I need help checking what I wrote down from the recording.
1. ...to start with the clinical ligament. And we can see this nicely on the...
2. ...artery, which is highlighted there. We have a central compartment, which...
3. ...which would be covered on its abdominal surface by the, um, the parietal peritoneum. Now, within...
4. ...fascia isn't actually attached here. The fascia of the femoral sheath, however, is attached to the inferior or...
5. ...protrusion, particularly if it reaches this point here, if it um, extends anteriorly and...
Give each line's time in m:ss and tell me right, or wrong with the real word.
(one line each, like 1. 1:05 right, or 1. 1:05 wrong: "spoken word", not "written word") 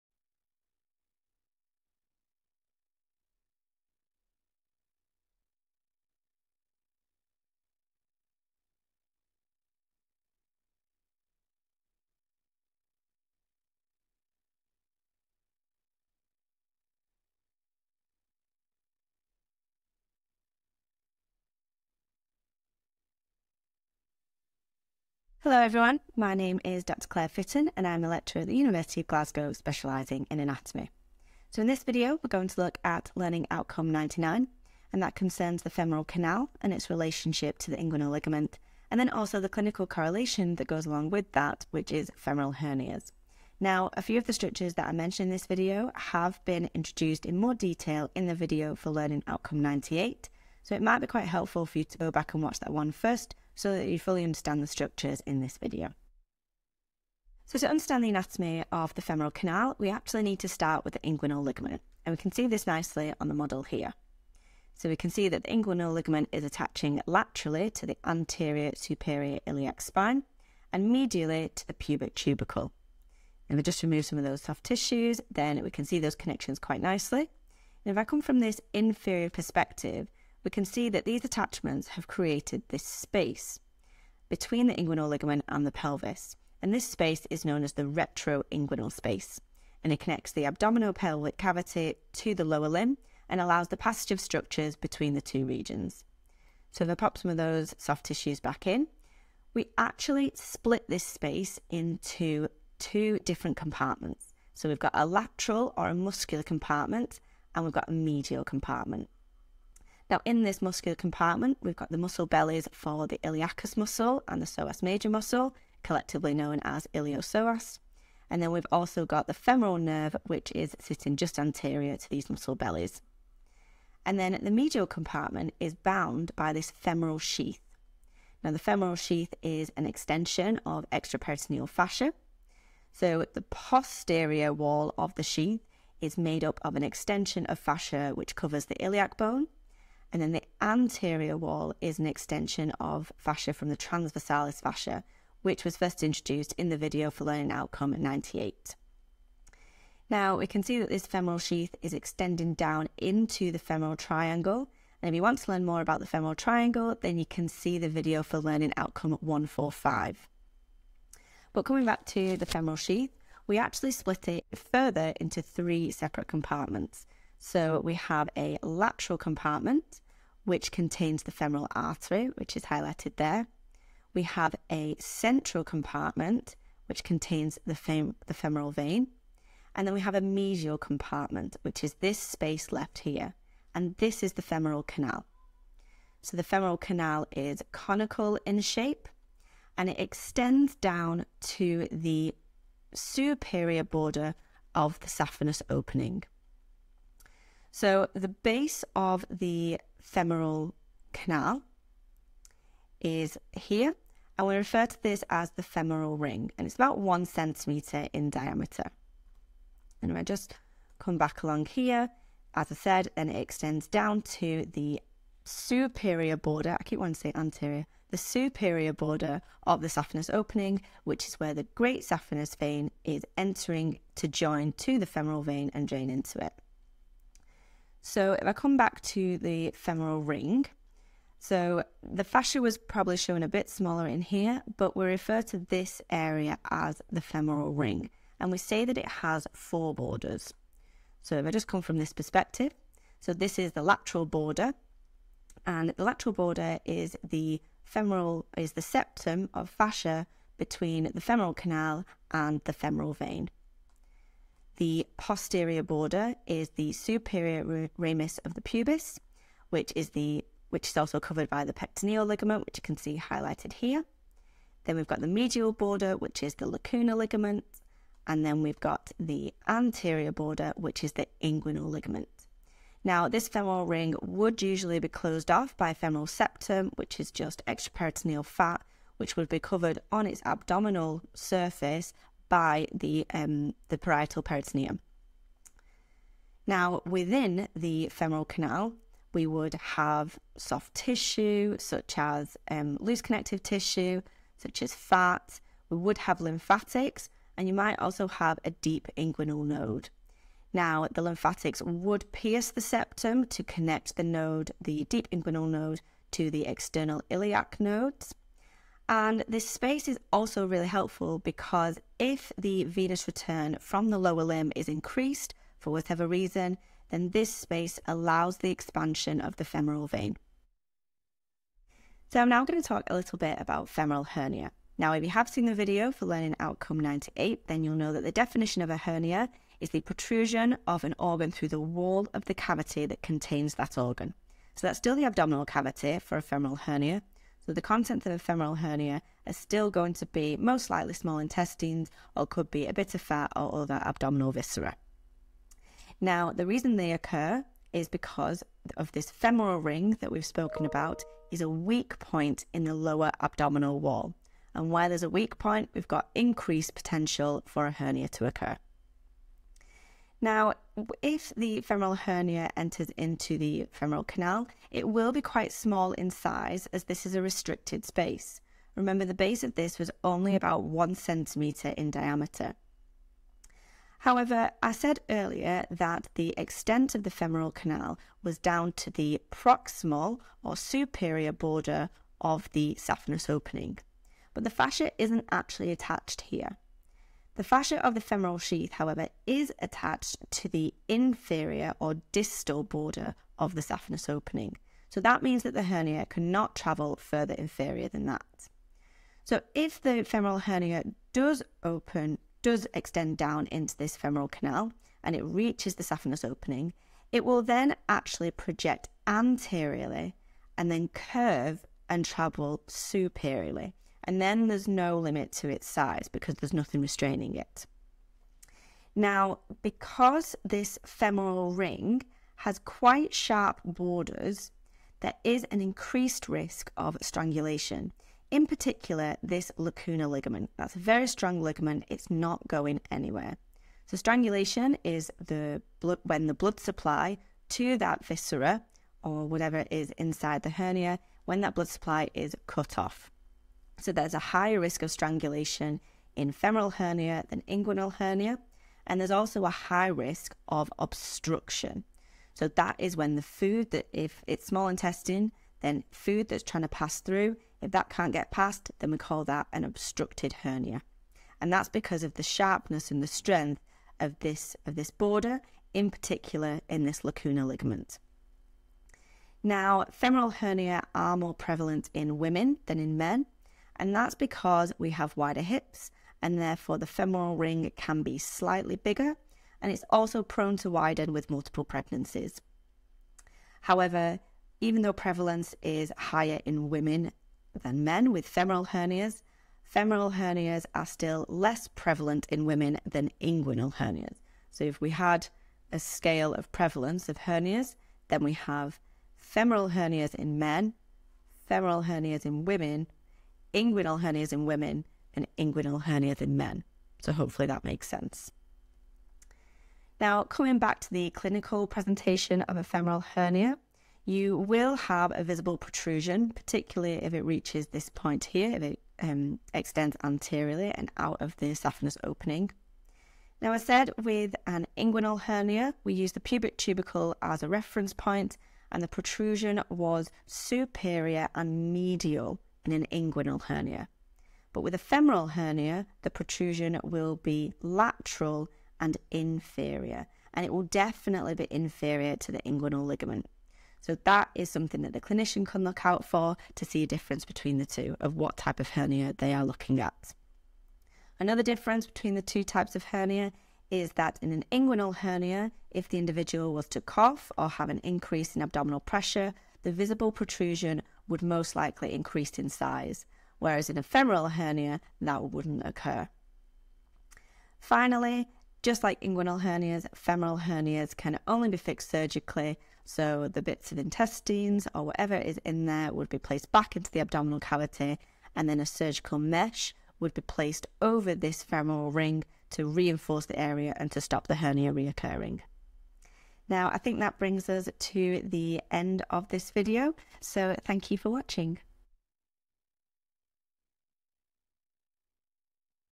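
1. 1:00 wrong: "inguinal", not "clinical"
2. 2:51 right
3. 4:39 right
4. 6:24 right
5. 8:35 right.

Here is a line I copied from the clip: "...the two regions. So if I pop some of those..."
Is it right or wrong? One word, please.
right.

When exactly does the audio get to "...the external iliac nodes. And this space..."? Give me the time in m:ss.
5:06.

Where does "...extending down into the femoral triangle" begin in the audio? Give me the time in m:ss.
2:31.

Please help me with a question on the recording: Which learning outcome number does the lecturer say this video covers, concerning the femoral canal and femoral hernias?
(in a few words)
99.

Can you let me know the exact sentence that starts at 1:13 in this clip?
And we just remove some of those soft tissues, then we can see those connections quite nicely.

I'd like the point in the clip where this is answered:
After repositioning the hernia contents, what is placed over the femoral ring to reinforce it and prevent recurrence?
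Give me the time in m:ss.
9:38.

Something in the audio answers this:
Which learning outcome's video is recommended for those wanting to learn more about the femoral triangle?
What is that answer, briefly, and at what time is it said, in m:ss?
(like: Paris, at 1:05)
145, at 2:38.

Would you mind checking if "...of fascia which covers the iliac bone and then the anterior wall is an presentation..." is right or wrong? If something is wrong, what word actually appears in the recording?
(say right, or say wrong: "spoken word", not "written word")
wrong: "extension", not "presentation".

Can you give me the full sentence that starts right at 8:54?
But with a femoral hernia, the protrusion will be lateral and inferior, and it will definitely be inferior to the inguinal ligament.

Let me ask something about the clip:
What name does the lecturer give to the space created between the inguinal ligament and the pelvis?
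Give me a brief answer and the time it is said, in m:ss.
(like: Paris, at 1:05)
Retroinguinal space, at 1:27.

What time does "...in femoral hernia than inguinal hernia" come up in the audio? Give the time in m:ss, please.
7:26.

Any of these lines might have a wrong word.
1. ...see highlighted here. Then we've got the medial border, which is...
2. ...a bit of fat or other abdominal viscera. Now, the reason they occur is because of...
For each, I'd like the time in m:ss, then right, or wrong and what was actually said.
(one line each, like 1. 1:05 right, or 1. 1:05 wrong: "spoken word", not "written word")
1. 4:22 right
2. 5:42 right.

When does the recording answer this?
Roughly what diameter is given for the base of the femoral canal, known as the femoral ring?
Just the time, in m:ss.
3:26.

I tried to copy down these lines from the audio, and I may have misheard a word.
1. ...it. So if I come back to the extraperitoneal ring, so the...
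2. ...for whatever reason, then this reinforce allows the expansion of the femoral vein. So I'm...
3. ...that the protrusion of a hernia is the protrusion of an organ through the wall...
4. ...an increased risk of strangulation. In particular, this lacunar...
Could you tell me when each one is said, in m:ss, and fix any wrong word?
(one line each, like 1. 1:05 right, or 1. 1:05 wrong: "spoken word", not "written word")
1. 3:46 wrong: "femoral", not "extraperitoneal"
2. 5:15 wrong: "space", not "reinforce"
3. 5:28 wrong: "definition", not "protrusion"
4. 7:05 right.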